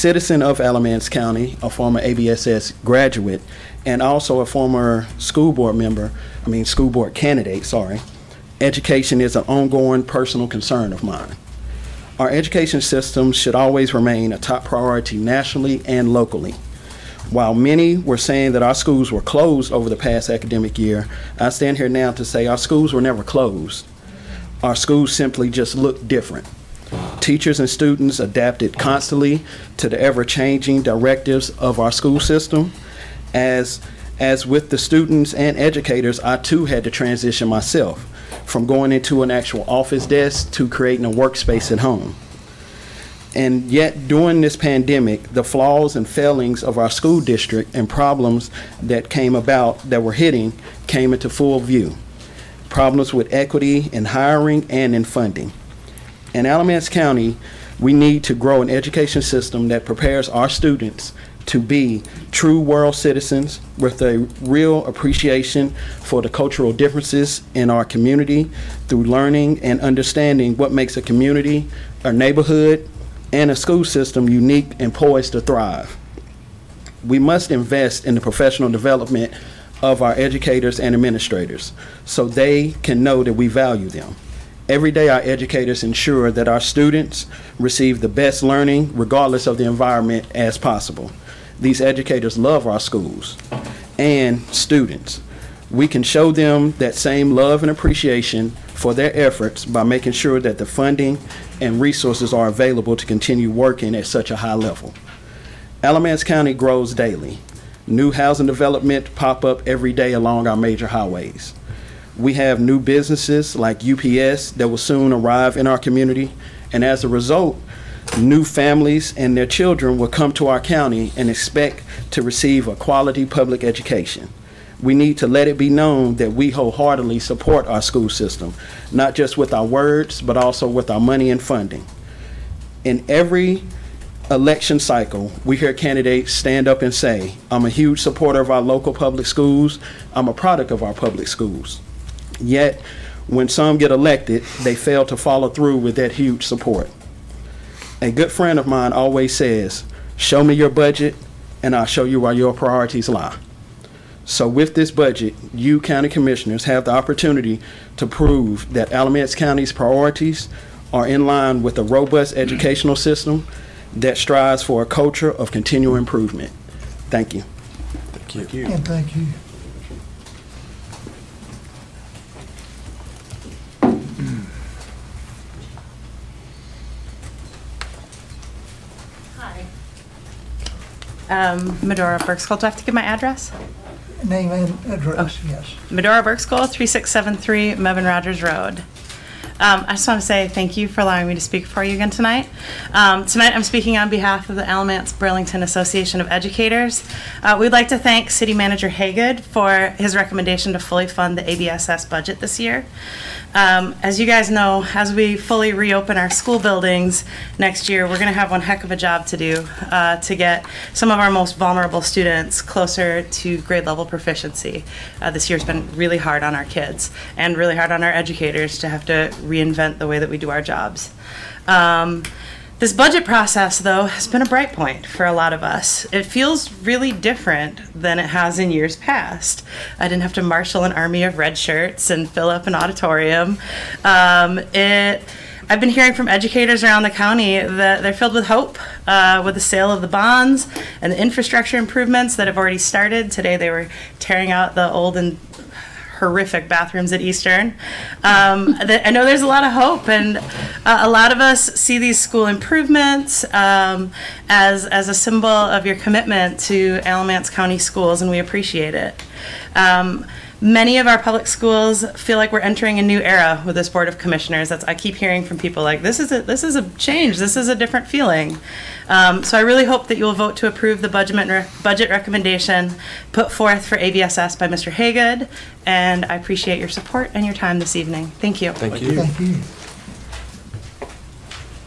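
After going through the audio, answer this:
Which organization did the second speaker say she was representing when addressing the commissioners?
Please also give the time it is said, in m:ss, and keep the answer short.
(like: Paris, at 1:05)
Alamance Burlington Association of Educators, at 3:14.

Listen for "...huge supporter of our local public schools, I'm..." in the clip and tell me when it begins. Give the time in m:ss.
2:17.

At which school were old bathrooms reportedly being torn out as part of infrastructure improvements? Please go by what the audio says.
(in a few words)
Eastern.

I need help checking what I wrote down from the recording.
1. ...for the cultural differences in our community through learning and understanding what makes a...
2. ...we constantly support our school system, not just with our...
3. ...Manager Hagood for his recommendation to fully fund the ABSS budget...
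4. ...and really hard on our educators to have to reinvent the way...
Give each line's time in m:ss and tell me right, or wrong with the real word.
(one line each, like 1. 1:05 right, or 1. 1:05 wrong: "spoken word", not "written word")
1. 1:05 right
2. 2:06 wrong: "wholeheartedly", not "constantly"
3. 3:18 right
4. 3:37 right.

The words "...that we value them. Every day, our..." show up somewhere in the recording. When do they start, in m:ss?
1:23.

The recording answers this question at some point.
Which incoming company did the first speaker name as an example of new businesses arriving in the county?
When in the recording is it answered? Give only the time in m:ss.
1:53.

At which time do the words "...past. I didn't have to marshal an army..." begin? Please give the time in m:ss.
3:48.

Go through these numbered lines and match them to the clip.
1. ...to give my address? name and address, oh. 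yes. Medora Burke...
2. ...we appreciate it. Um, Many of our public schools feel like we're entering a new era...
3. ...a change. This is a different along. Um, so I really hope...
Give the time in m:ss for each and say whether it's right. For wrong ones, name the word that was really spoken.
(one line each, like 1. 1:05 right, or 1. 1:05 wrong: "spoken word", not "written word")
1. 3:02 right
2. 4:18 right
3. 4:26 wrong: "feeling", not "along".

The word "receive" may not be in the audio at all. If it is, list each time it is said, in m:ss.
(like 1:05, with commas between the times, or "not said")
1:27, 2:02.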